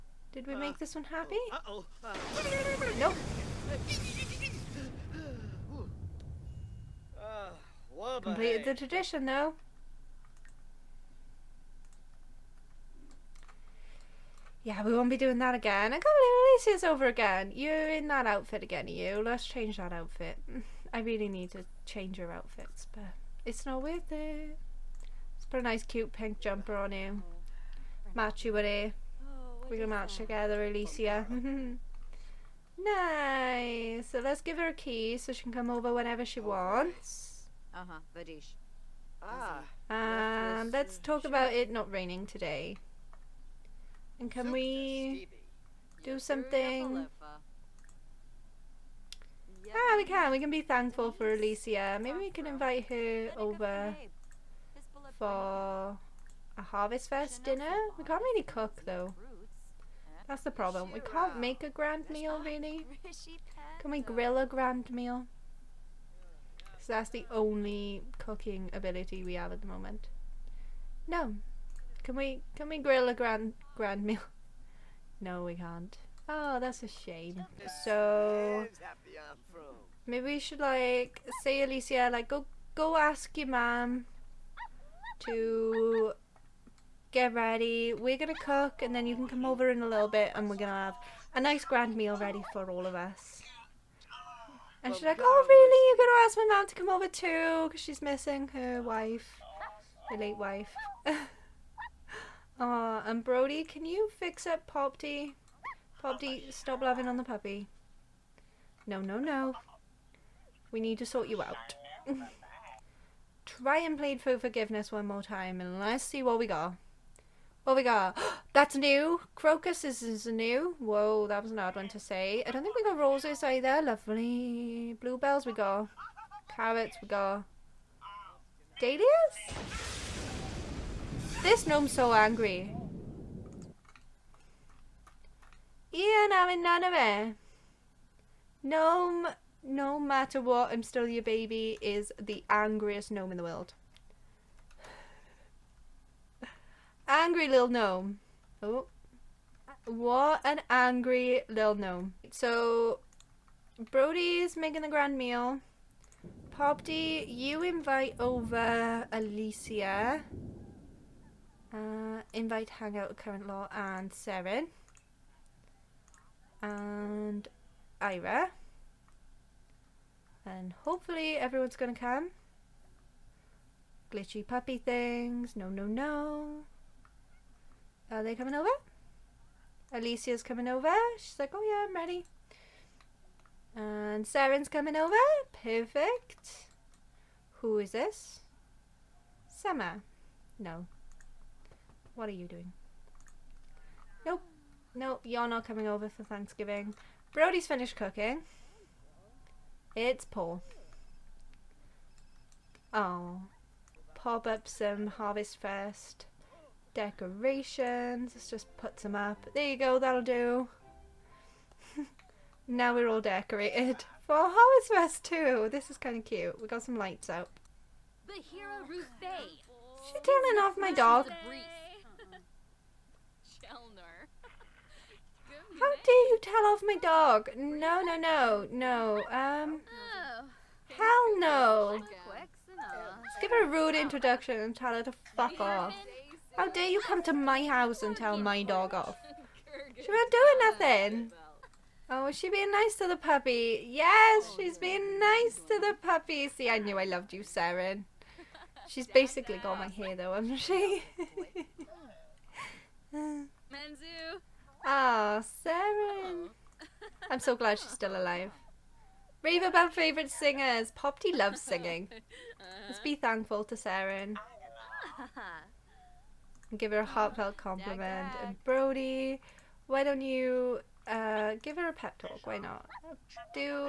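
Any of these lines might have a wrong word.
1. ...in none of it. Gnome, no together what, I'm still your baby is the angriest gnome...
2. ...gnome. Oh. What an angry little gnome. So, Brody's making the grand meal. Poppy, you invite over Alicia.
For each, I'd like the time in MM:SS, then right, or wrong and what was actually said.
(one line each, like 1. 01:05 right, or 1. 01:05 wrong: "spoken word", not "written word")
1. 02:16 wrong: "matter", not "together"
2. 02:27 right.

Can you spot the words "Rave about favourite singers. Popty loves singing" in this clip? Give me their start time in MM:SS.
04:19.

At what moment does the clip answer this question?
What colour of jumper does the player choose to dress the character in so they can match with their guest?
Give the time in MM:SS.
00:26.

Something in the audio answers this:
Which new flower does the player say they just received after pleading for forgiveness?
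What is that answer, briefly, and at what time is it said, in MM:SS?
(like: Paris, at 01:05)
Crocus, at 01:59.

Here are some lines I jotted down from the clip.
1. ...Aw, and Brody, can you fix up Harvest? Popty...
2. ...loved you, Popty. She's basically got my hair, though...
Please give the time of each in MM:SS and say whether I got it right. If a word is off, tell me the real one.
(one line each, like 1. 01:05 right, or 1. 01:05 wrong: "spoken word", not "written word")
1. 01:42 wrong: "Popty", not "Harvest"
2. 04:07 wrong: "Saren", not "Popty".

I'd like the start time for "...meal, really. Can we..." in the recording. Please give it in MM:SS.
01:02.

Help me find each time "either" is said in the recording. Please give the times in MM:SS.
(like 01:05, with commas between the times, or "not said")
02:03.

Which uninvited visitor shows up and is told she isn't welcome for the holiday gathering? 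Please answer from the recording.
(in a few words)
Summer.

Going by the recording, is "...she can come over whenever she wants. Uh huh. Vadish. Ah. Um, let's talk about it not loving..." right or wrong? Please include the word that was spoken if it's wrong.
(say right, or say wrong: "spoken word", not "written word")
wrong: "raining", not "loving".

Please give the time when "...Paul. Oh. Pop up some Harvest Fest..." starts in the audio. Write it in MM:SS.
03:20.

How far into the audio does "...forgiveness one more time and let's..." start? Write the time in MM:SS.
01:54.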